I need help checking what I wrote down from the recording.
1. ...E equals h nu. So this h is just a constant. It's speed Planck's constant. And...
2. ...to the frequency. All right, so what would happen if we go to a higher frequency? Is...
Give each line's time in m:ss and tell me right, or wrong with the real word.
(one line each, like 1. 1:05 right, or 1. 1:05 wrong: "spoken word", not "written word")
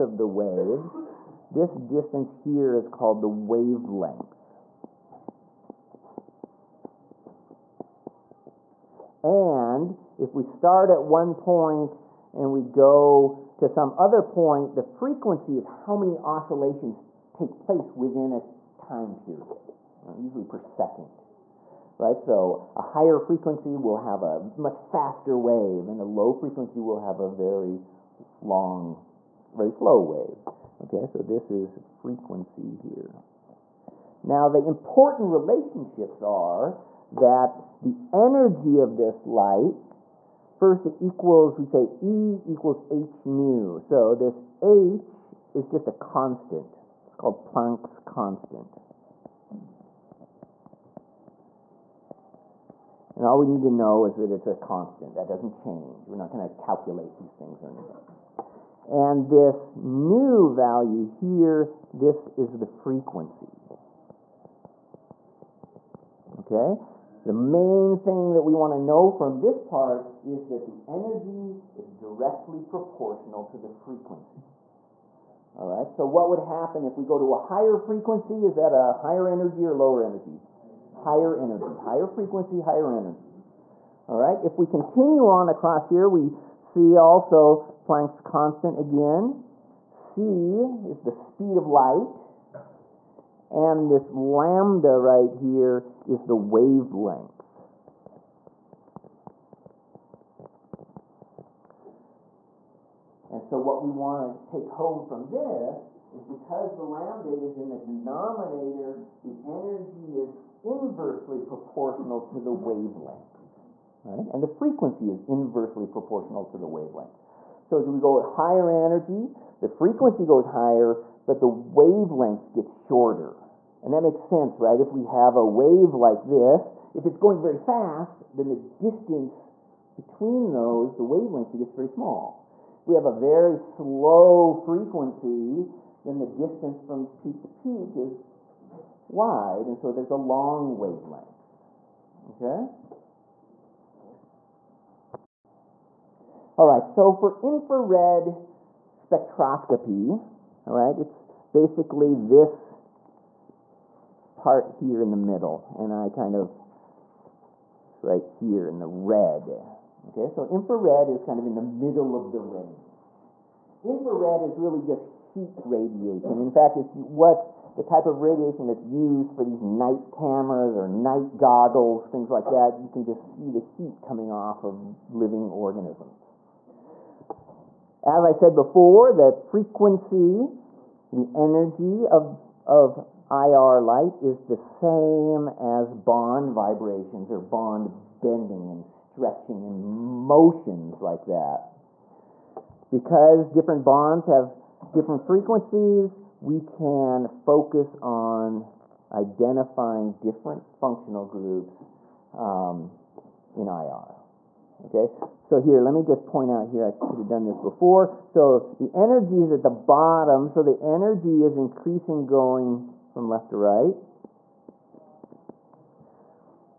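1. 0:42 wrong: "called", not "speed"
2. 1:13 right.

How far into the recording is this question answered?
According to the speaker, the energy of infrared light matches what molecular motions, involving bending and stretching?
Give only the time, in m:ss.
3:05.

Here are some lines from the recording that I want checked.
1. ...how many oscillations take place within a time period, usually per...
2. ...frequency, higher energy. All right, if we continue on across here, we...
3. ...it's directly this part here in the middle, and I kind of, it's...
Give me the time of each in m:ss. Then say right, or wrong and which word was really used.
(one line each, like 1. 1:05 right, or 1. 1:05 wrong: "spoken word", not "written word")
1. 0:15 right
2. 1:22 right
3. 2:30 wrong: "basically", not "directly".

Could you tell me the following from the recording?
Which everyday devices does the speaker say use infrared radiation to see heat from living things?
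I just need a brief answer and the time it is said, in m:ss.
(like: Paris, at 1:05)
Night goggles, at 2:50.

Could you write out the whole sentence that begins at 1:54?
And the frequency is inversely proportional to the wavelength.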